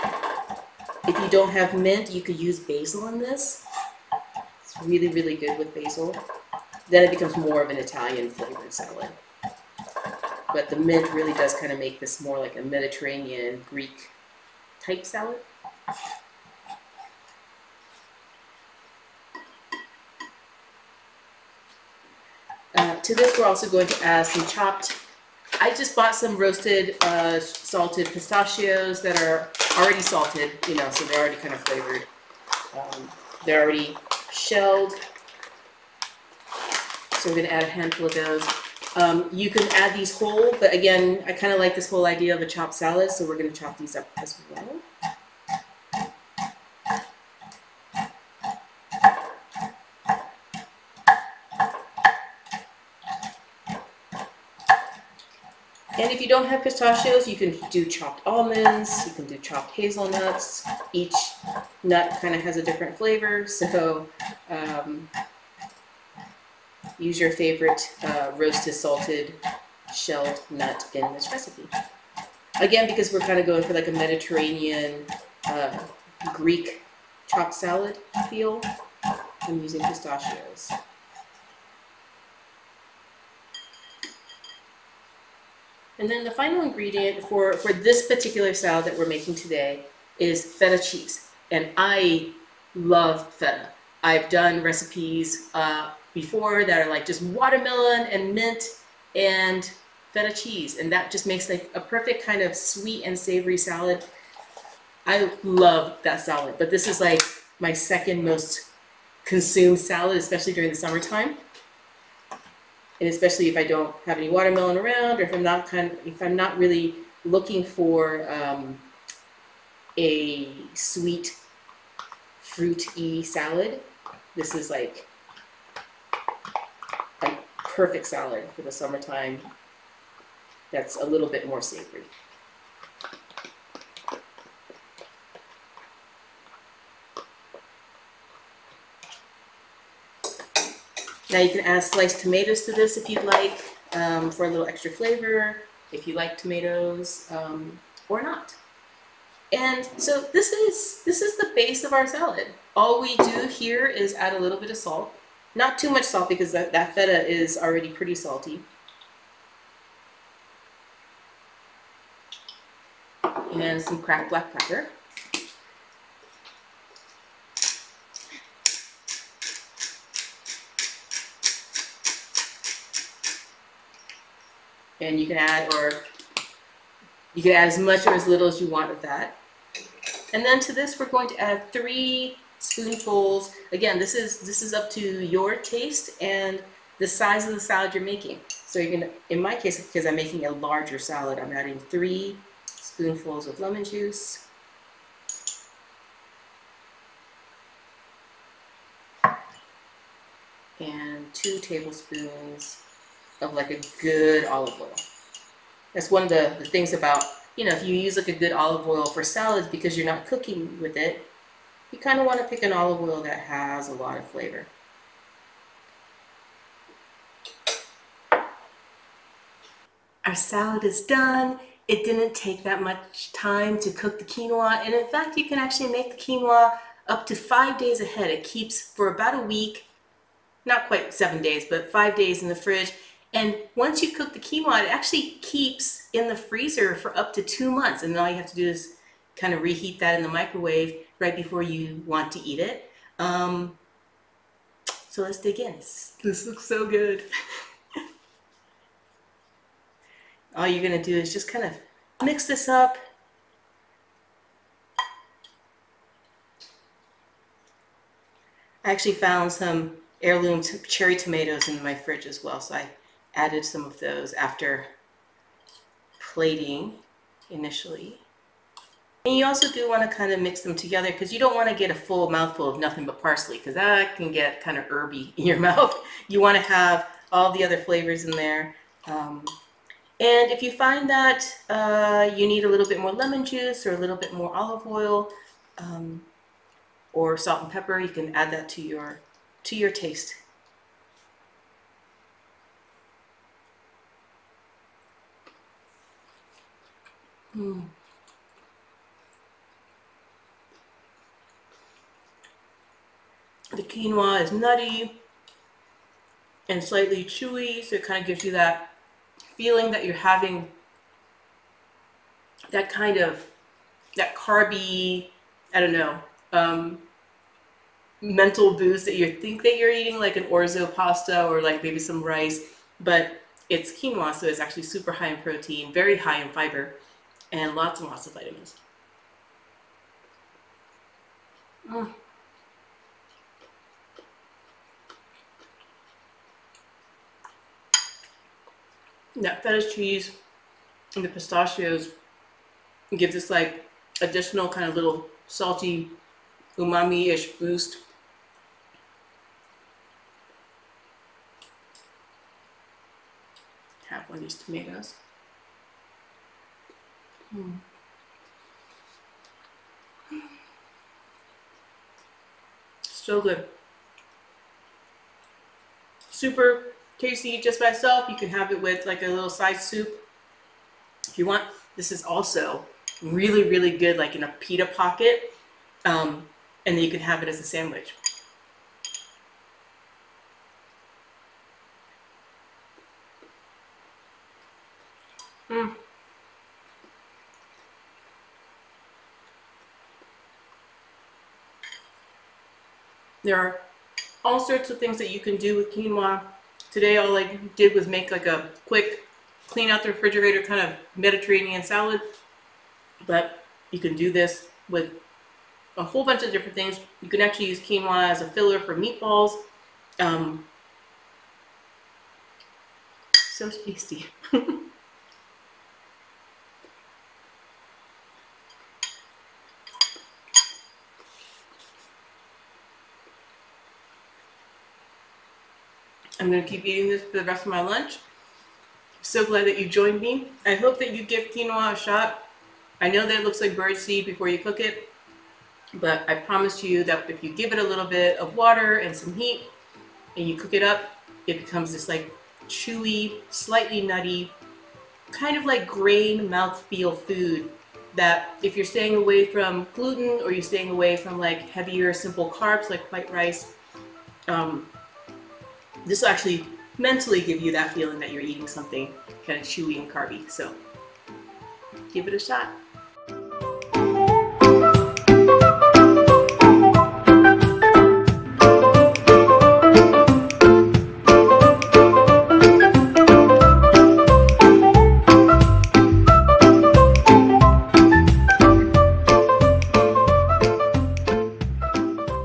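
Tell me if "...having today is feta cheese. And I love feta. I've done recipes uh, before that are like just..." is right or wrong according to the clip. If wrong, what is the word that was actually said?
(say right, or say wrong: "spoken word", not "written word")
wrong: "making", not "having".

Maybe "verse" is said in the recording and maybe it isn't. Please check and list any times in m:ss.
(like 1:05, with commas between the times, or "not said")
not said.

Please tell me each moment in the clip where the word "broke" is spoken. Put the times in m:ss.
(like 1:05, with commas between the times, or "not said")
not said.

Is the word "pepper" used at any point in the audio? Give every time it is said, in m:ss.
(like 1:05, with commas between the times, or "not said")
2:44, 4:47.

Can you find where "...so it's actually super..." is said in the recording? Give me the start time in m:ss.
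5:24.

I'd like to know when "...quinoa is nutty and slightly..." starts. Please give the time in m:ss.
5:03.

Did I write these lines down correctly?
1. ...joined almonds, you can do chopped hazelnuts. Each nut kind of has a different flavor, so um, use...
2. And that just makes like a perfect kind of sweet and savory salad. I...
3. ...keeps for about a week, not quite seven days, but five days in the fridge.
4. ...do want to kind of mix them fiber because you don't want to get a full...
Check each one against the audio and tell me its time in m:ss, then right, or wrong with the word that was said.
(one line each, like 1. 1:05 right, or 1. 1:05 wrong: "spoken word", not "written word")
1. 0:57 wrong: "chopped", not "joined"
2. 1:40 right
3. 3:48 right
4. 4:29 wrong: "together", not "fiber".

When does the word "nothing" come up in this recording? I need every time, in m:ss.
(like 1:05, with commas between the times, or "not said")
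4:32.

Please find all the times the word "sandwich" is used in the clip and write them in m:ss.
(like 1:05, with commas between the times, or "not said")
6:17.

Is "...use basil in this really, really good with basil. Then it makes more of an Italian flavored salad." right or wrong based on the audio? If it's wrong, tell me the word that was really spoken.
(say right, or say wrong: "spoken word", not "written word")
wrong: "becomes", not "makes".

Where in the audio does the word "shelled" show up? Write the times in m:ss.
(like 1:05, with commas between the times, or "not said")
0:34, 1:09.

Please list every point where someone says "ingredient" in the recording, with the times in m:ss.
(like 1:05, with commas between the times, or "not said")
1:26.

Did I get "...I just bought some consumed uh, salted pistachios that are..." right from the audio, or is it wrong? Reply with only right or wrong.
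wrong.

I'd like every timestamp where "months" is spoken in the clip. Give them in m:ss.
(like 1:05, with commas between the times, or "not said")
3:57.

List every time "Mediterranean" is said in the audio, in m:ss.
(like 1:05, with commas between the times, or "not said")
0:12, 1:13, 6:41.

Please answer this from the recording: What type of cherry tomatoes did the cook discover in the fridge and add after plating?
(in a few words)
heirloom.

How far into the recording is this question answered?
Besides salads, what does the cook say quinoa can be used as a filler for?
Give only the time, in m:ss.
6:48.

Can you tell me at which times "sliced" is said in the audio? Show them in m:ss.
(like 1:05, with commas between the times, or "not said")
2:21.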